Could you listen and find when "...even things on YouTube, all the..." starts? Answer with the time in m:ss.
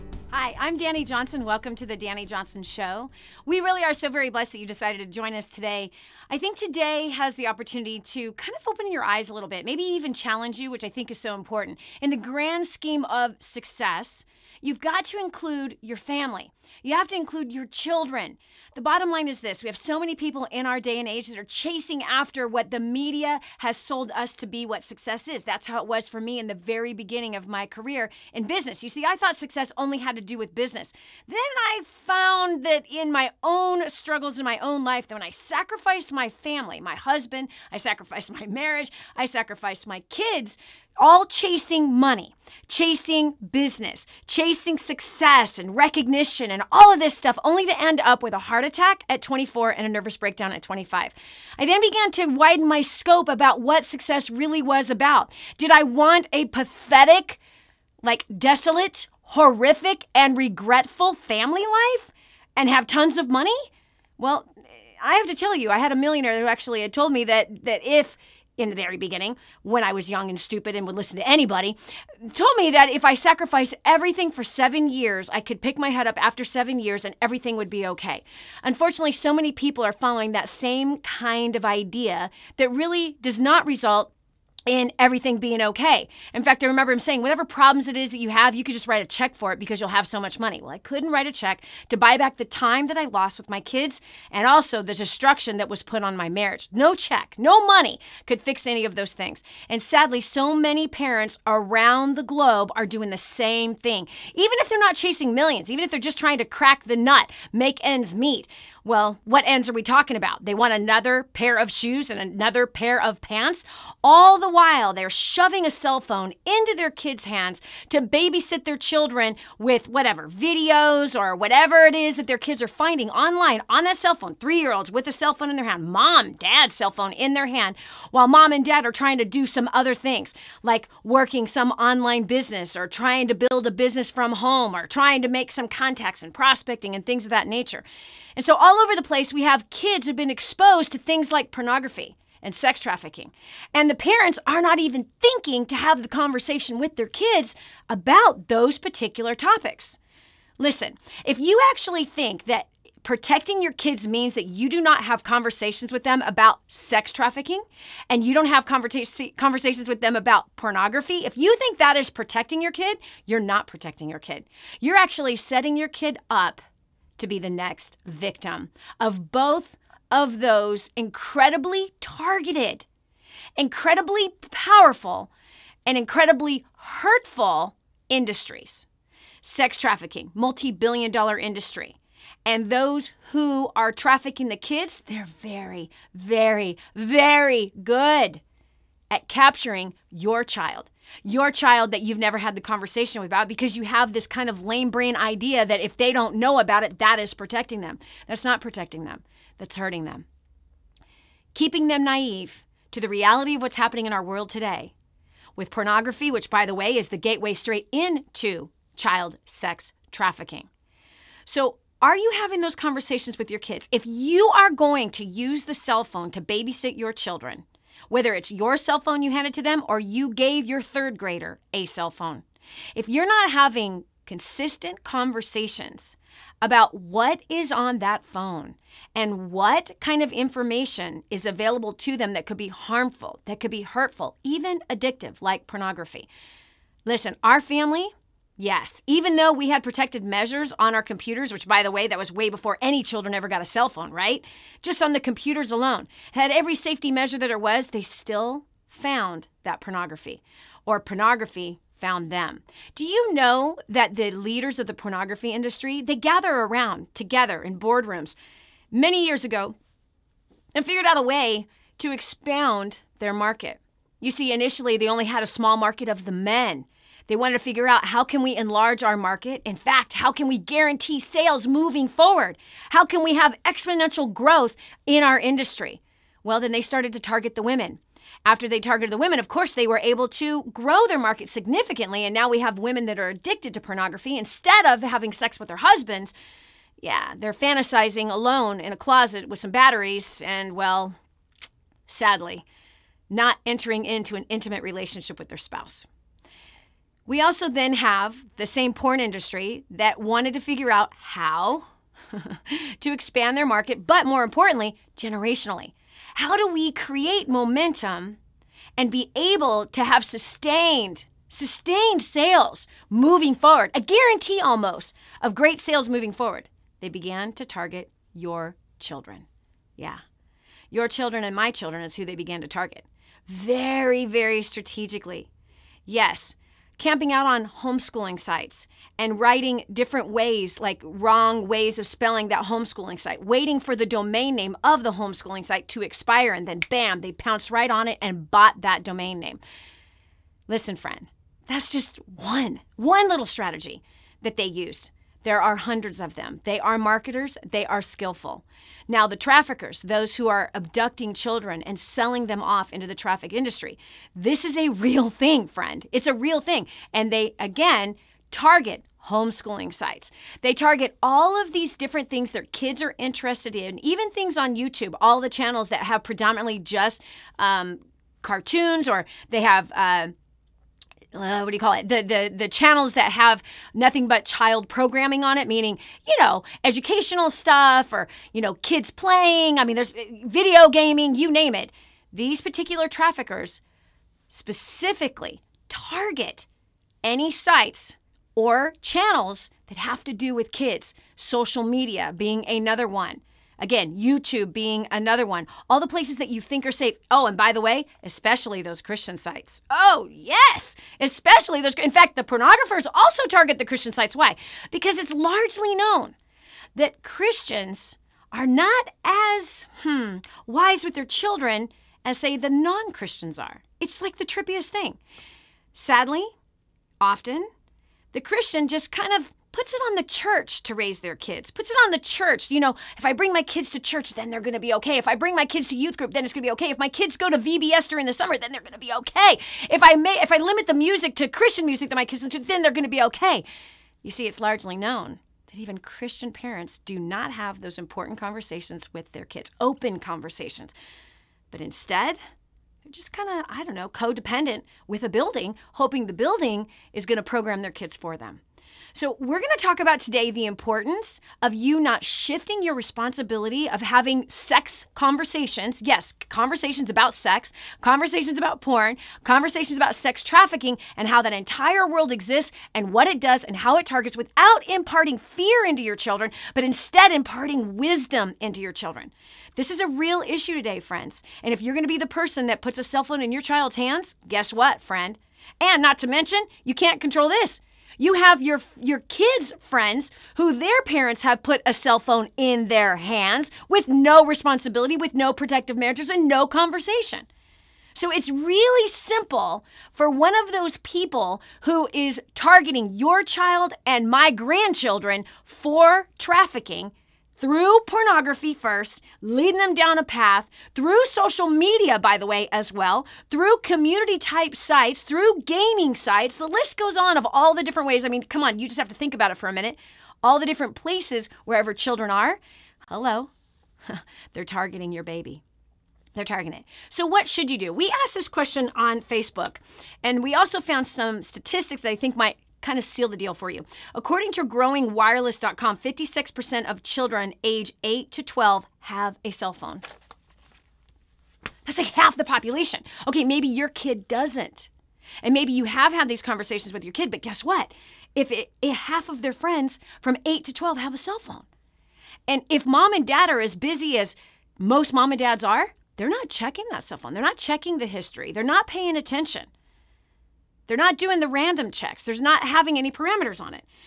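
6:04.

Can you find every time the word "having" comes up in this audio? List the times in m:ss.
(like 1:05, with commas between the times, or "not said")
3:32, 3:43, 4:45, 7:34, 9:12.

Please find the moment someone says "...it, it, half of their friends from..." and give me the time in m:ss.
8:58.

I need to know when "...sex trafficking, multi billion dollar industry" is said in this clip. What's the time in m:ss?
2:59.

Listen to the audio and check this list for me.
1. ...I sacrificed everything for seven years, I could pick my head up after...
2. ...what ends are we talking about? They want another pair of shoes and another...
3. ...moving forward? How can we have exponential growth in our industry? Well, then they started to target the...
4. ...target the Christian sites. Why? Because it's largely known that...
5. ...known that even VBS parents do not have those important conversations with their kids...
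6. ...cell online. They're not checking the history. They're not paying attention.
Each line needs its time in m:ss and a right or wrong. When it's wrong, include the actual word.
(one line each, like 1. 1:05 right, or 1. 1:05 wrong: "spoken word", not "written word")
1. 1:13 right
2. 1:49 right
3. 4:31 right
4. 6:43 right
5. 7:14 wrong: "Christian", not "VBS"
6. 9:07 wrong: "phone", not "online".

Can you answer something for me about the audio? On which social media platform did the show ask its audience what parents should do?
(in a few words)
Facebook.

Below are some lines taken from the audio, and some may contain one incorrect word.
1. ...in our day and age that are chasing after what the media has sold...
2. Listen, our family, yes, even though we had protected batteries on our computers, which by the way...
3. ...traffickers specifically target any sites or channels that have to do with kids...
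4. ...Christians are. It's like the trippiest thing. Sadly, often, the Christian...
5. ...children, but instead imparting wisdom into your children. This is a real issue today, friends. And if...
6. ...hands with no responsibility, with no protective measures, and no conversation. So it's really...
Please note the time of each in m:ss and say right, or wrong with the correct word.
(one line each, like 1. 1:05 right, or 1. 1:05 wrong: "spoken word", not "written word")
1. 0:20 right
2. 3:57 wrong: "measures", not "batteries"
3. 6:23 right
4. 6:53 right
5. 7:46 right
6. 8:03 right.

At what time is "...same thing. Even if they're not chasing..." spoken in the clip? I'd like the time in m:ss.
1:43.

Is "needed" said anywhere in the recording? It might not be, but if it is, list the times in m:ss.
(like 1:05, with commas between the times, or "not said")
not said.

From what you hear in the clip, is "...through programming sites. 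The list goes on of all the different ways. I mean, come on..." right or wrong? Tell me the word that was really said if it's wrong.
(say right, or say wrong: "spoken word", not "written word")
wrong: "gaming", not "programming".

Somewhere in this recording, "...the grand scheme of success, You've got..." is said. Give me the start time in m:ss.
0:12.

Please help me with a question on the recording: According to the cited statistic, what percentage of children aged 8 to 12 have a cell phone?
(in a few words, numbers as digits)
56%.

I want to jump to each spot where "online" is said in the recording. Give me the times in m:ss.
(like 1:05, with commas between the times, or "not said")
2:03, 2:11.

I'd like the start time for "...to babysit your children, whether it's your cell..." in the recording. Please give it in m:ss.
3:36.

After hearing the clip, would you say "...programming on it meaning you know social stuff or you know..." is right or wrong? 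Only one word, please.
wrong.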